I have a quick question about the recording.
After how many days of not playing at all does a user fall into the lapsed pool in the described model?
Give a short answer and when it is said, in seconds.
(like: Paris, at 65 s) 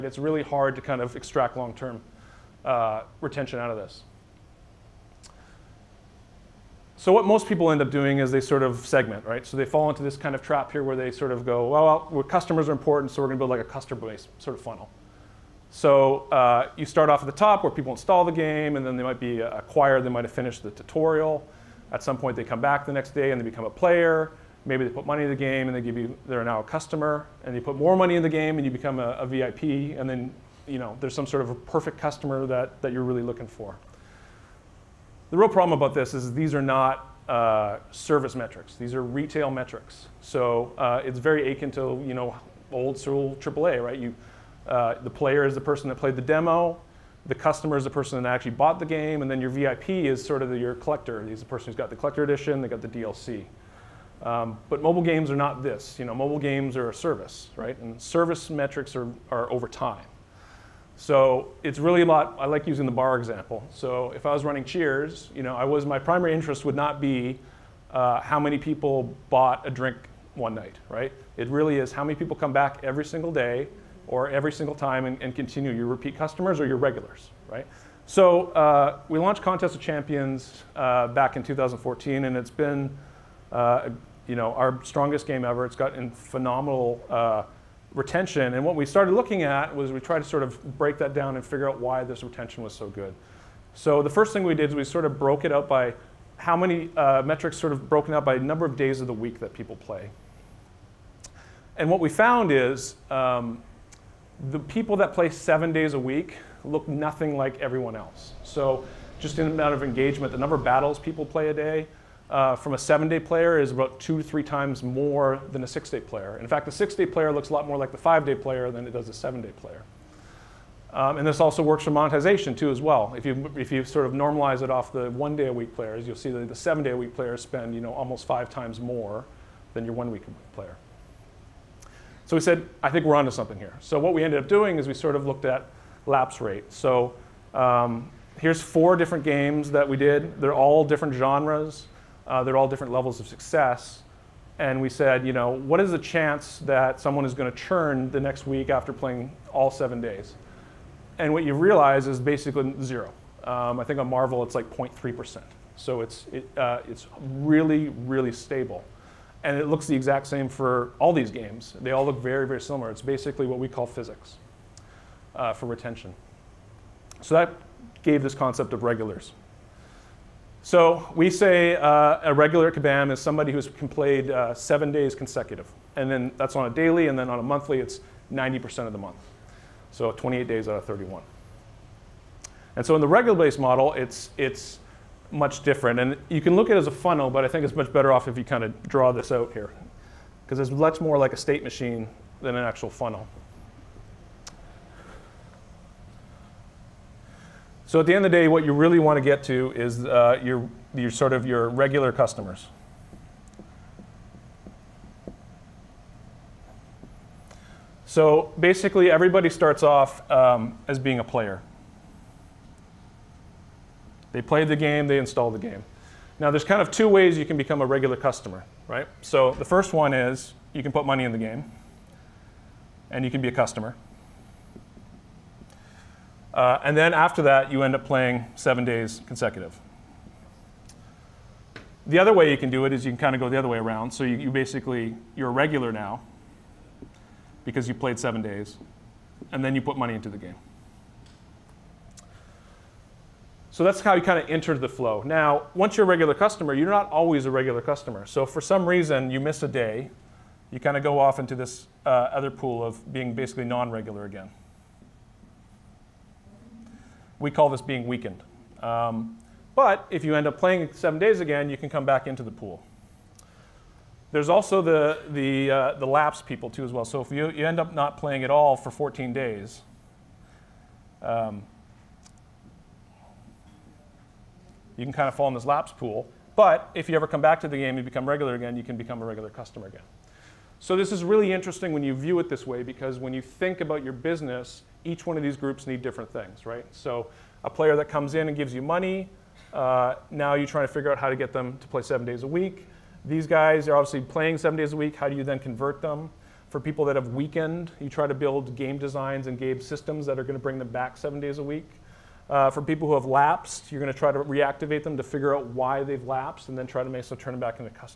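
14, at 268 s.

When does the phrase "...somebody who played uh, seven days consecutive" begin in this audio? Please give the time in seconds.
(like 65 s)
173 s.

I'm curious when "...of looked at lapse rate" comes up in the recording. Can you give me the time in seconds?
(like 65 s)
135 s.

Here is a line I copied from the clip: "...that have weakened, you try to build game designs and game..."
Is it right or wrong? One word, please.
right.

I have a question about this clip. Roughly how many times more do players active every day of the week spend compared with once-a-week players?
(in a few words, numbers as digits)
5.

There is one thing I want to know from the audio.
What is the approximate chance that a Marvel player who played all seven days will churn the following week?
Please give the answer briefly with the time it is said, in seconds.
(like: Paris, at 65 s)
0.3%, at 154 s.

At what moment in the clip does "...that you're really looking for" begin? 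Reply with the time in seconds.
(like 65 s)
32 s.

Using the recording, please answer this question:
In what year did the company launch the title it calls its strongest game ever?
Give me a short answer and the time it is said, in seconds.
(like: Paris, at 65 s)
2014, at 81 s.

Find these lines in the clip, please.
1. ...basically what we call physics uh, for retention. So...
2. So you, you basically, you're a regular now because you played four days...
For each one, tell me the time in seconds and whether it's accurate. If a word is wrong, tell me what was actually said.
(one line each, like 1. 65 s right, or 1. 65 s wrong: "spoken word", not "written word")
1. 163 s right
2. 234 s wrong: "seven", not "four".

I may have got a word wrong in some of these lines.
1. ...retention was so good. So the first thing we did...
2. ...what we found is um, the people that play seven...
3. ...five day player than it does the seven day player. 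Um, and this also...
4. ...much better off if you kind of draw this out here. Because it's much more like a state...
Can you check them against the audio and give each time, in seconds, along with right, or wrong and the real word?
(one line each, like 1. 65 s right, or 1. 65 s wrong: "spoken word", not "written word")
1. 92 s right
2. 101 s right
3. 117 s right
4. 187 s right.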